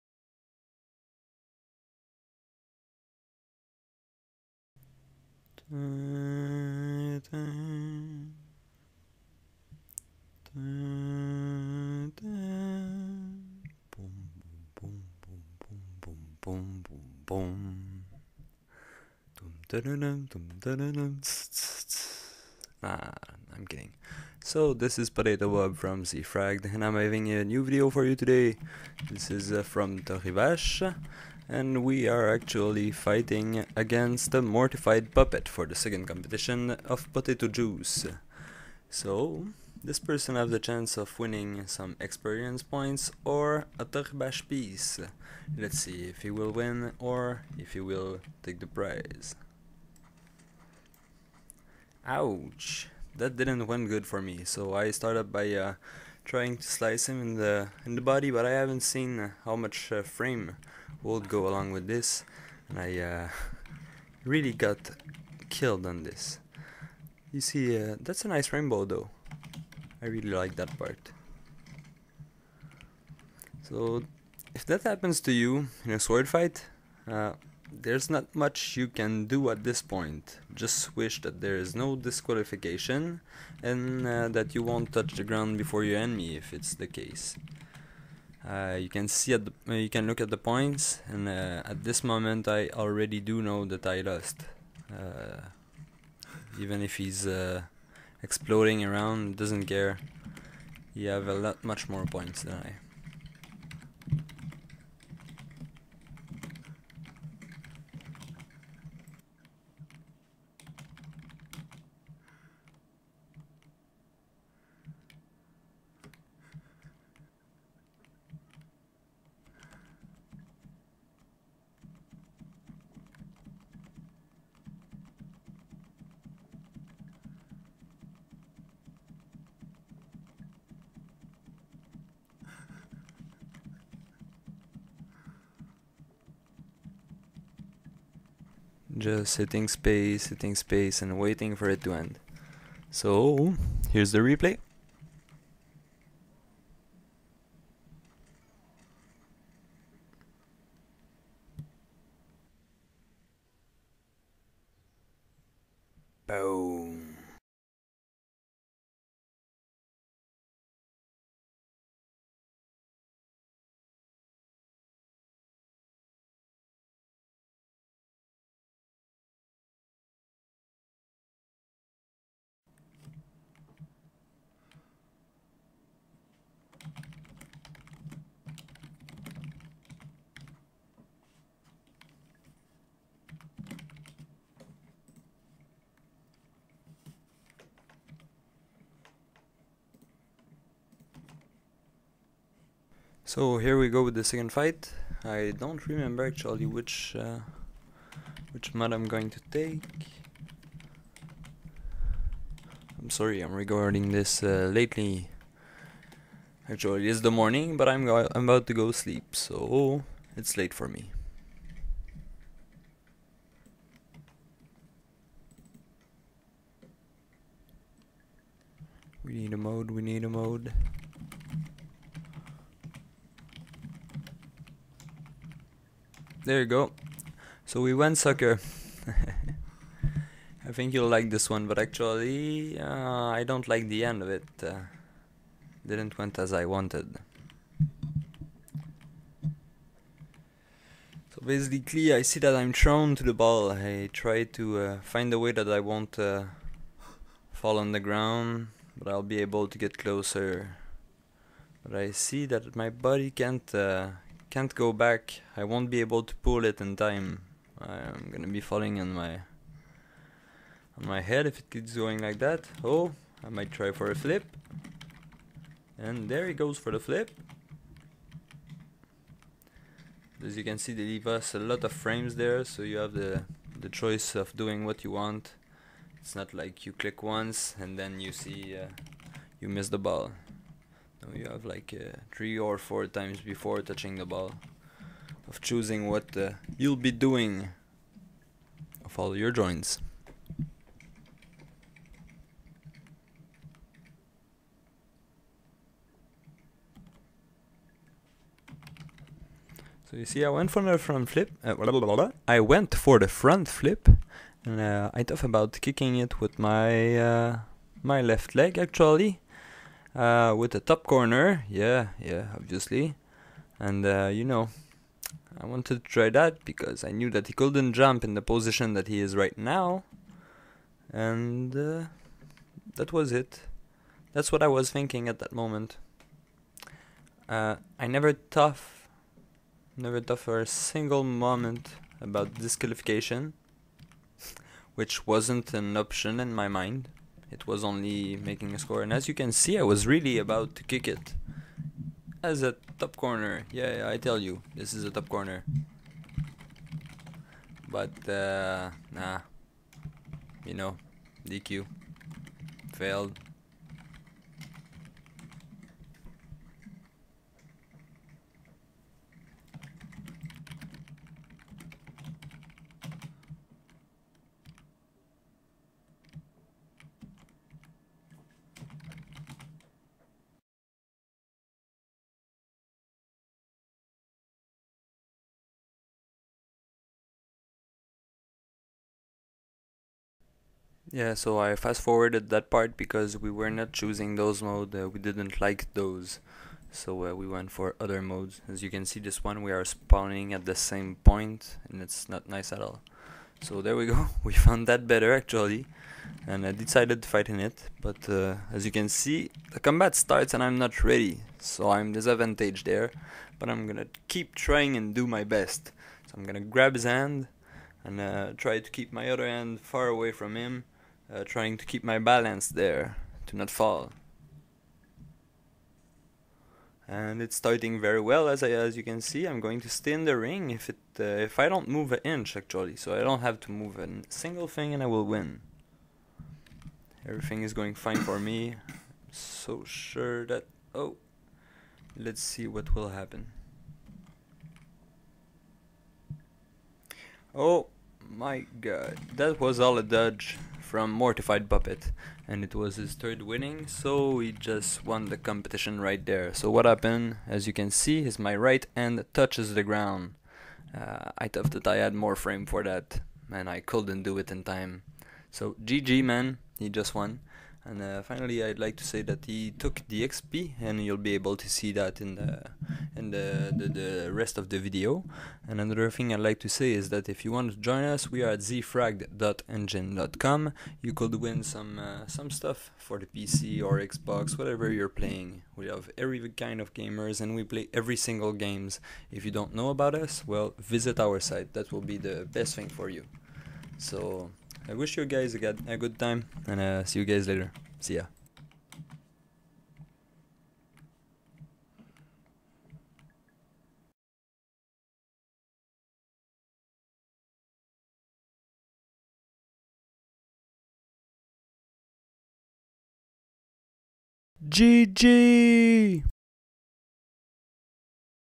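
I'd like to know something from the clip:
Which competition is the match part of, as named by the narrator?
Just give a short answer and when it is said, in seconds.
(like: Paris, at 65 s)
potato juice, at 37 s.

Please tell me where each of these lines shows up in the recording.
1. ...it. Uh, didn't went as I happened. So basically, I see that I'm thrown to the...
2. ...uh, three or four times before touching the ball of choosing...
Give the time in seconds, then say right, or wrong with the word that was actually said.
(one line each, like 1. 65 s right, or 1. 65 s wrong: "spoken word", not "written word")
1. 234 s wrong: "wanted", not "happened"
2. 281 s right.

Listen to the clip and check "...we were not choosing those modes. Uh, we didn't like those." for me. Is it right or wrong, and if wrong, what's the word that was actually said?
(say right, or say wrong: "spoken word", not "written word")
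right.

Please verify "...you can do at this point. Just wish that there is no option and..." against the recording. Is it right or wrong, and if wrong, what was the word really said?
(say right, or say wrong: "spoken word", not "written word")
wrong: "disqualification", not "option".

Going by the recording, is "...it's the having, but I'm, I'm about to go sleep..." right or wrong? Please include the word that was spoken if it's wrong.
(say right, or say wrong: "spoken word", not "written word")
wrong: "morning", not "having".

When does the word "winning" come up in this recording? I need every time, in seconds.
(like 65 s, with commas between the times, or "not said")
41 s, 443 s.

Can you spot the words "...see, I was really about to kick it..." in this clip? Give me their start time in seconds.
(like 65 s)
339 s.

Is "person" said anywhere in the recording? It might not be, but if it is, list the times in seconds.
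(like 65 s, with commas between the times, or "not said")
39 s.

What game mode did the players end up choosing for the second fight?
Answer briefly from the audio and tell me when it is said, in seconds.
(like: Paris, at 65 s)
soccer, at 228 s.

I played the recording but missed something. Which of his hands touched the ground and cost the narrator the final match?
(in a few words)
right hand.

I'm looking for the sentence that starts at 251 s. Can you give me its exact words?
But I see that my body can't uh, can't go back.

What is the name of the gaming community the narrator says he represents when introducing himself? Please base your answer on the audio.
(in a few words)
Zfrag.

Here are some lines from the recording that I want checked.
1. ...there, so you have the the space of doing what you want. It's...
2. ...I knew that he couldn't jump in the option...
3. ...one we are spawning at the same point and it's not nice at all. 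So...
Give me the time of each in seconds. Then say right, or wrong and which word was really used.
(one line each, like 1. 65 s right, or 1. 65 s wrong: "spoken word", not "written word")
1. 272 s wrong: "choice", not "space"
2. 317 s wrong: "position", not "option"
3. 389 s right.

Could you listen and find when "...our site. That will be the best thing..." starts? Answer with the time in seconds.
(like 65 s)
481 s.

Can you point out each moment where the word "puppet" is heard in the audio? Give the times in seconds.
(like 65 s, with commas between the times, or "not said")
35 s, 441 s.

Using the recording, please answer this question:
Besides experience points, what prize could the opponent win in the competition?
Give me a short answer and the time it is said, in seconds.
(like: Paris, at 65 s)
A Toribash piece, at 43 s.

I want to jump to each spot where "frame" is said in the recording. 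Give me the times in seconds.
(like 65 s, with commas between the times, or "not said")
60 s, 271 s, 452 s.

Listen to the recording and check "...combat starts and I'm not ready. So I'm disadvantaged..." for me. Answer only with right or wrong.
right.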